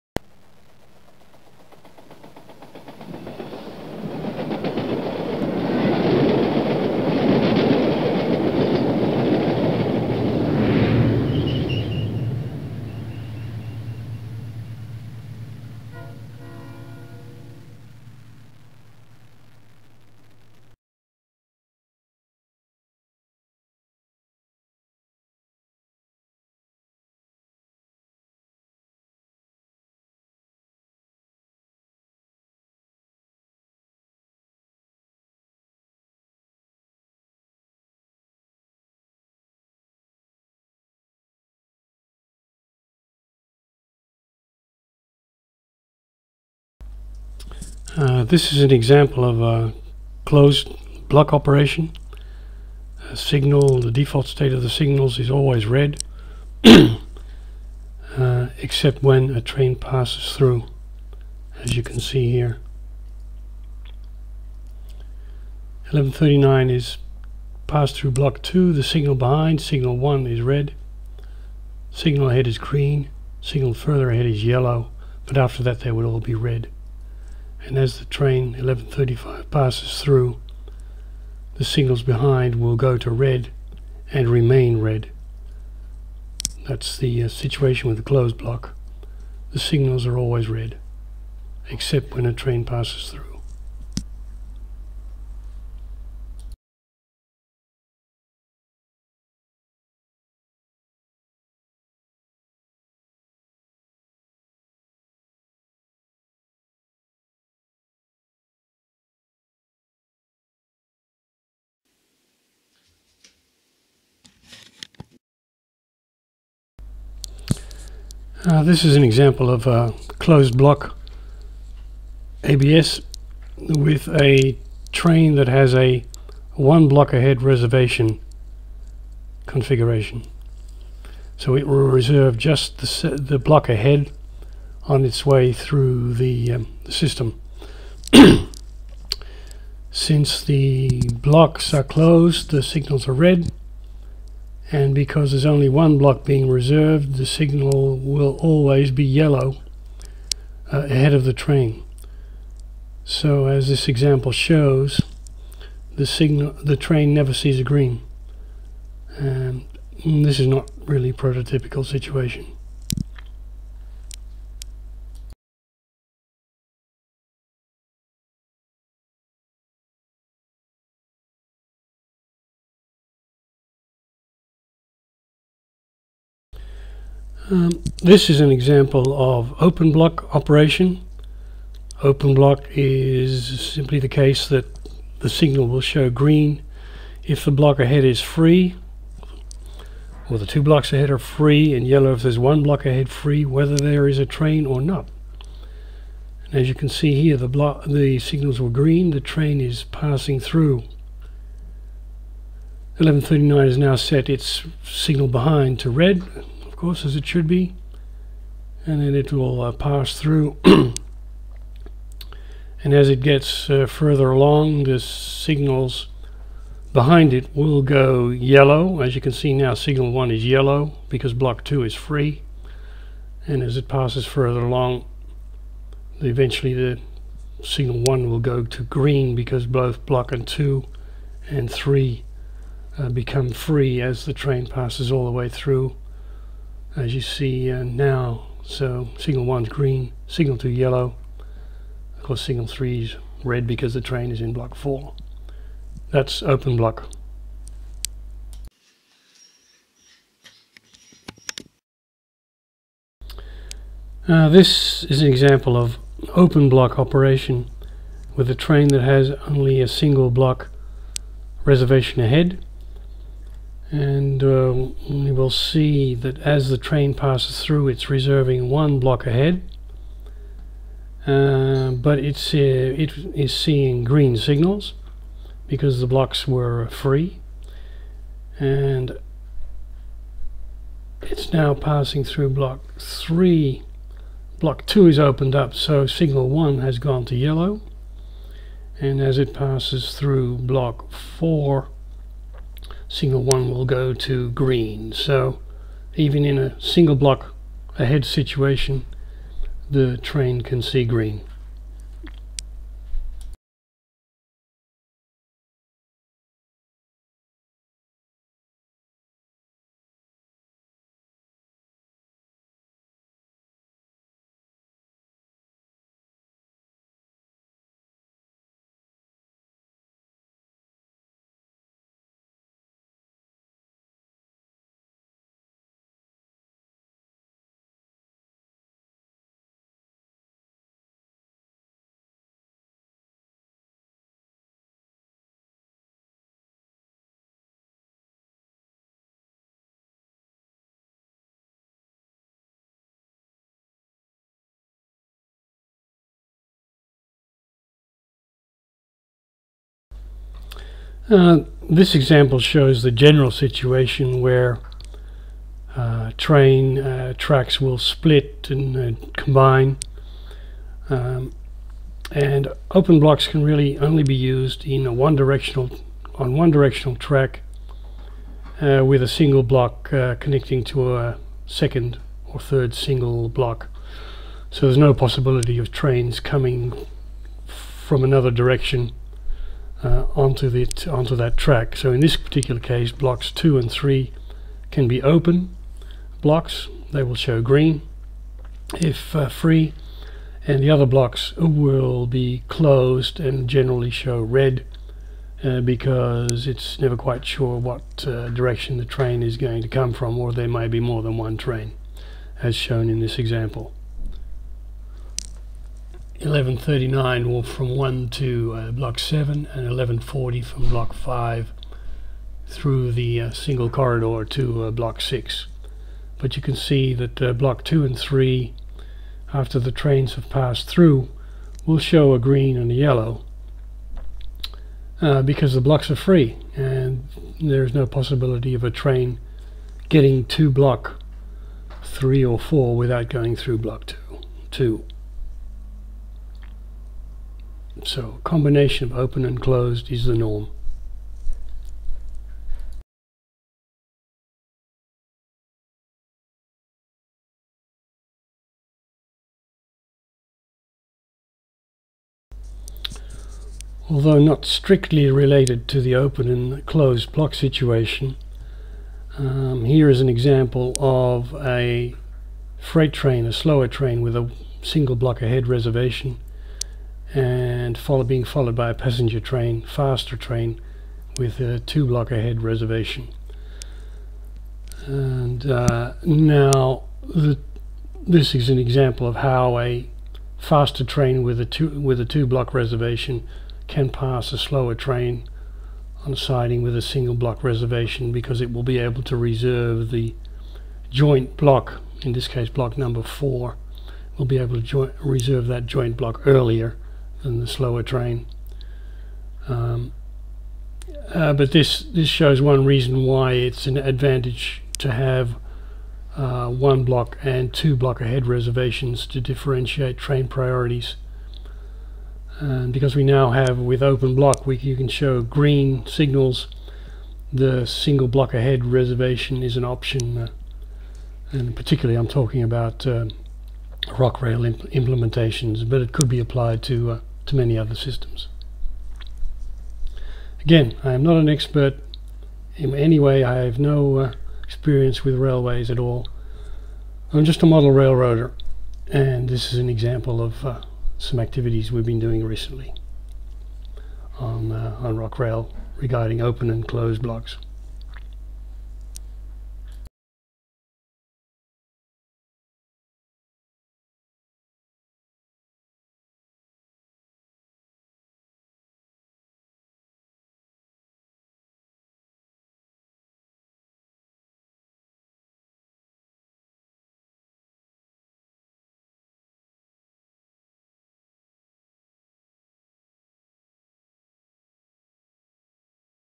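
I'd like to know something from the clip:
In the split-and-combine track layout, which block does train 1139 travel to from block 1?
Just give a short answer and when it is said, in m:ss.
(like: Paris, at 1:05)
Block 7, at 6:48.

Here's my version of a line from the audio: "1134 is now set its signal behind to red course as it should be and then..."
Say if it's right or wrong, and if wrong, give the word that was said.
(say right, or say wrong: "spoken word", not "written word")
wrong: "1139", not "1134".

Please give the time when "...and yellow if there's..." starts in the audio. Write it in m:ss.
3:11.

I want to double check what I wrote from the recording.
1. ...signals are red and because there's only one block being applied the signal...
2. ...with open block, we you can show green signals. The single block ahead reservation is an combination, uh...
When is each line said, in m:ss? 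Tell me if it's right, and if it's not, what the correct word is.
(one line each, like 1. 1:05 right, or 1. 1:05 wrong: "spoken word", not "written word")
1. 2:22 wrong: "reserved", not "applied"
2. 8:33 wrong: "option", not "combination".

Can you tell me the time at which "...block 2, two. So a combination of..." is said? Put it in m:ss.
7:13.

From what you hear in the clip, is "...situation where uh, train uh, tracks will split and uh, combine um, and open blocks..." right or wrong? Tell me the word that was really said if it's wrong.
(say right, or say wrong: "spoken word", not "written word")
right.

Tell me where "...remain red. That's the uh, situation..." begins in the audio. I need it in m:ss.
1:24.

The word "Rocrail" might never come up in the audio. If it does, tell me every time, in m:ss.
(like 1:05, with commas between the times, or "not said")
8:44, 9:05.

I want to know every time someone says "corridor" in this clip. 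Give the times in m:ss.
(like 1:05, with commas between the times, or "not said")
6:53.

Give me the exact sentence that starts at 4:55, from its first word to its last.
So even in a single block ahead situation, the train can see green.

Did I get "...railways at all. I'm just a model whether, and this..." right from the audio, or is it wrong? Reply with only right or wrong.
wrong.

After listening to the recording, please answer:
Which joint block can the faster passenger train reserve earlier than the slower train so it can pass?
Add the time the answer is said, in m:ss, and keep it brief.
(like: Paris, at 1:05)
Block 4, at 8:12.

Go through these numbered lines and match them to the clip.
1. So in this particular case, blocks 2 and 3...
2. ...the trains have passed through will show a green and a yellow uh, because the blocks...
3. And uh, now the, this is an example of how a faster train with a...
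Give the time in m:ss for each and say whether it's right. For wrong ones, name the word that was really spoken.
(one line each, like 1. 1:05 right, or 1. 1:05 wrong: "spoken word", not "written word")
1. 6:21 right
2. 6:59 right
3. 7:55 right.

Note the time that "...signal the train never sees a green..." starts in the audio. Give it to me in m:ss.
2:36.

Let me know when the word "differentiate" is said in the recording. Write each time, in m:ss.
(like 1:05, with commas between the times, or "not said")
8:29.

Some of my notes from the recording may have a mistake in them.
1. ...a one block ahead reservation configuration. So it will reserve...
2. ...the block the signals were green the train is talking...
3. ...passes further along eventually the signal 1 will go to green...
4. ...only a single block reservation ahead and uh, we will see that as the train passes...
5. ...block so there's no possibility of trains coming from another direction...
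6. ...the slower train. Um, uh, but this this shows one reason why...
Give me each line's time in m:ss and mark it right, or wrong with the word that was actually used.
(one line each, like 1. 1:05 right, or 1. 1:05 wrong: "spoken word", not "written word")
1. 2:05 right
2. 3:17 wrong: "passing", not "talking"
3. 3:43 right
4. 4:19 right
5. 6:13 right
6. 8:17 right.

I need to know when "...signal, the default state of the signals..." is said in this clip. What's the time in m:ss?
0:53.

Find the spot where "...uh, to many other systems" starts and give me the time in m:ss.
8:47.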